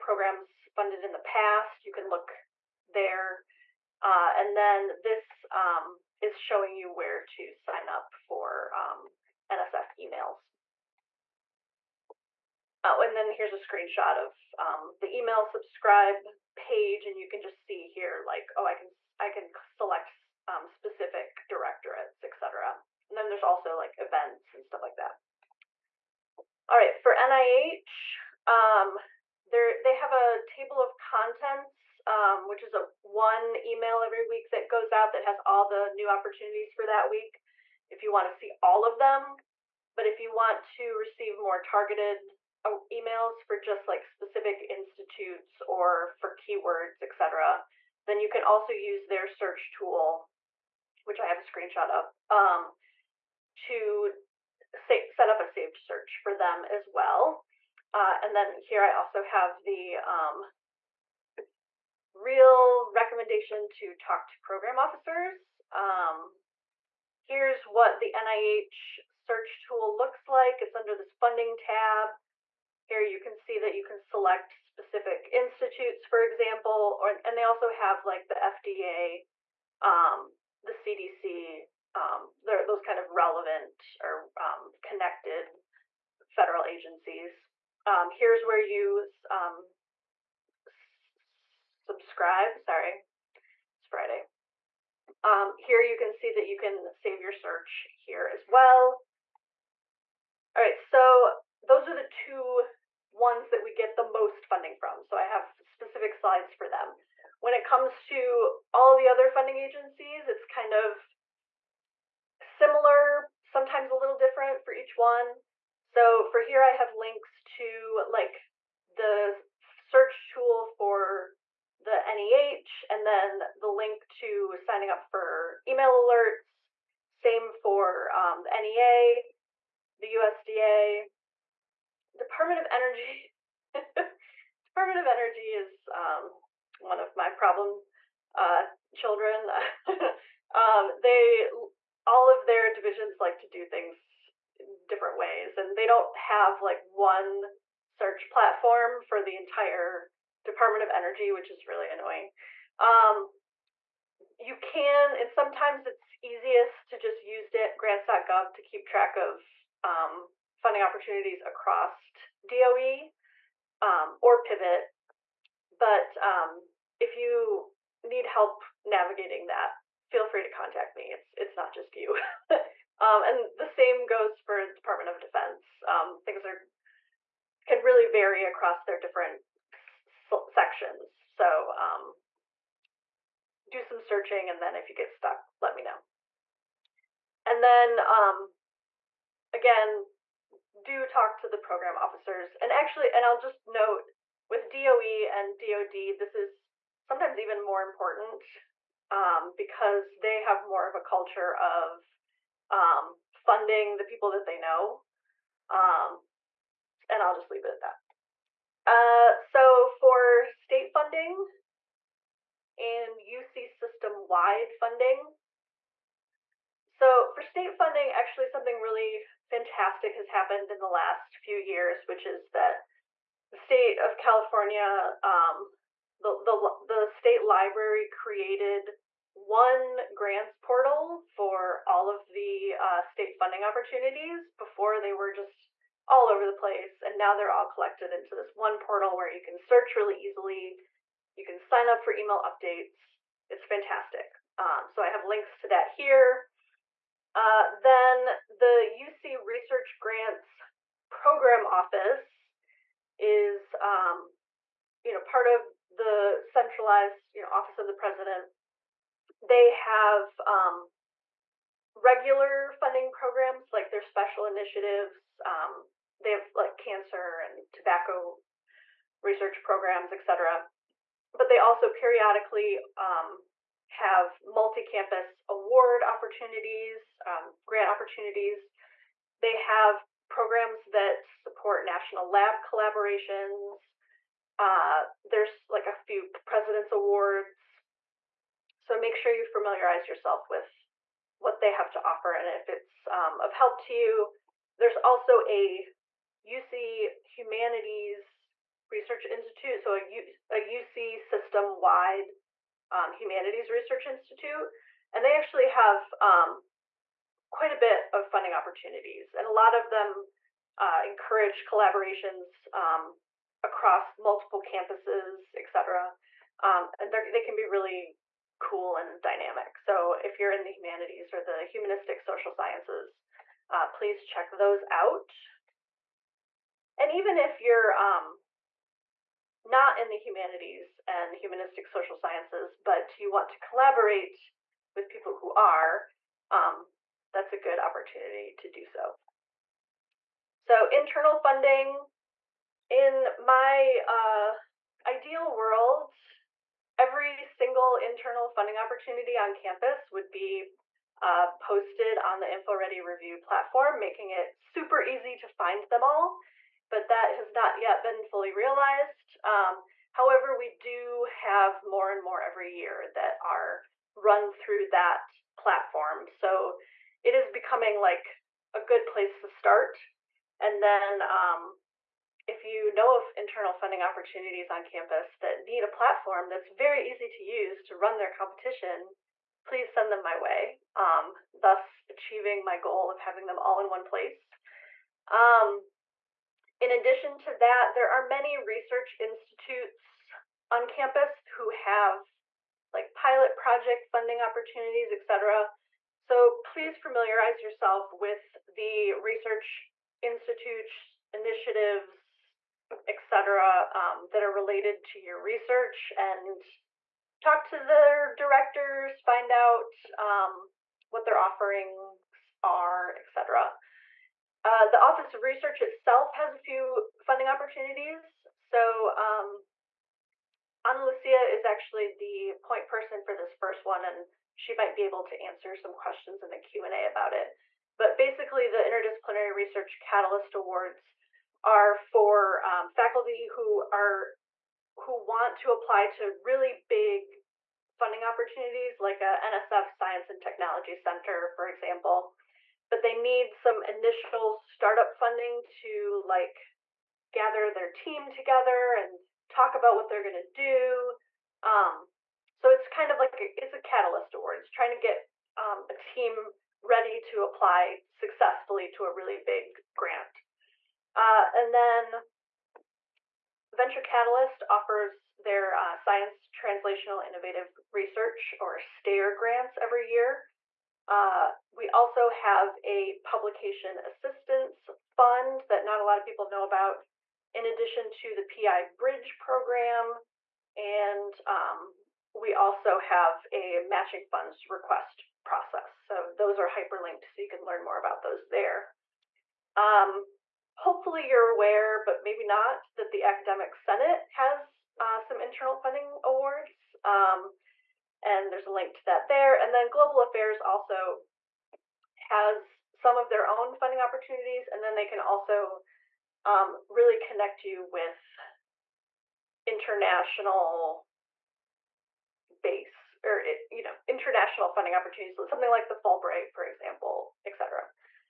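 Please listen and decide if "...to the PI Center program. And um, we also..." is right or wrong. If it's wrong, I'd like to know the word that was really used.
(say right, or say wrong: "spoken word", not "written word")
wrong: "Bridge", not "Center".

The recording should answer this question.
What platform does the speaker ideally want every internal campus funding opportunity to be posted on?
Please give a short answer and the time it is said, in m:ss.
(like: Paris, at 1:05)
InfoReady, at 5:52.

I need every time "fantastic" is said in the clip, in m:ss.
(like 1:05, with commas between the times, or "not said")
3:39, 4:03.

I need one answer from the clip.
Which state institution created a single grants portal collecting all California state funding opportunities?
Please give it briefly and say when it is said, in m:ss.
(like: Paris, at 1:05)
the state library, at 3:46.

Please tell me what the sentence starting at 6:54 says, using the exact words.
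Uh, the Office of Research itself has a few funding opportunities.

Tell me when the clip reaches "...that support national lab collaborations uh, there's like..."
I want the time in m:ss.
4:40.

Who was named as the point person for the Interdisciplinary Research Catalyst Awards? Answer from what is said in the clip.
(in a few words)
Ana Lucia.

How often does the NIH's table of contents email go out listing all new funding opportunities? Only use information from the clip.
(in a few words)
every week.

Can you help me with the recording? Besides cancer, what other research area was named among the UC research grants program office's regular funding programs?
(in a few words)
tobacco.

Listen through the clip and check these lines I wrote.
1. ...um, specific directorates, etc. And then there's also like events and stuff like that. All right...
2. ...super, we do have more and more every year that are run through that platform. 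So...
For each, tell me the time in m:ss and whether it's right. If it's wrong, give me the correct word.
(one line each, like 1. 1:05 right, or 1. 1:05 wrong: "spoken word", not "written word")
1. 0:20 right
2. 6:00 wrong: "however", not "super".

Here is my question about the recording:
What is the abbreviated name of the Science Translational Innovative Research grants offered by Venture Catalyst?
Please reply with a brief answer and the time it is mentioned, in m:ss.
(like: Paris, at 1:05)
STAIR, at 7:48.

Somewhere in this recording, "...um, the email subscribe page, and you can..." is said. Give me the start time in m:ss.
0:14.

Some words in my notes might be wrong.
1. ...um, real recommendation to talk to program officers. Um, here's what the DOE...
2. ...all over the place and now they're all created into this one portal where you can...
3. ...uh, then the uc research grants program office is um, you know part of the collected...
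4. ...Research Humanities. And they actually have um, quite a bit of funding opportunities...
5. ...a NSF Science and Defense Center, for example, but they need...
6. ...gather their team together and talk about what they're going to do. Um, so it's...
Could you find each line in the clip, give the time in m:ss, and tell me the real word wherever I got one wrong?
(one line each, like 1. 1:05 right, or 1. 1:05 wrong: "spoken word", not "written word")
1. 0:59 wrong: "NIH", not "DOE"
2. 3:56 wrong: "collected", not "created"
3. 4:07 wrong: "centralized", not "collected"
4. 5:03 wrong: "Institute", not "Humanities"
5. 7:19 wrong: "Technology", not "Defense"
6. 7:27 right.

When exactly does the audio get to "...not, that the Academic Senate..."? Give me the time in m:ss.
8:12.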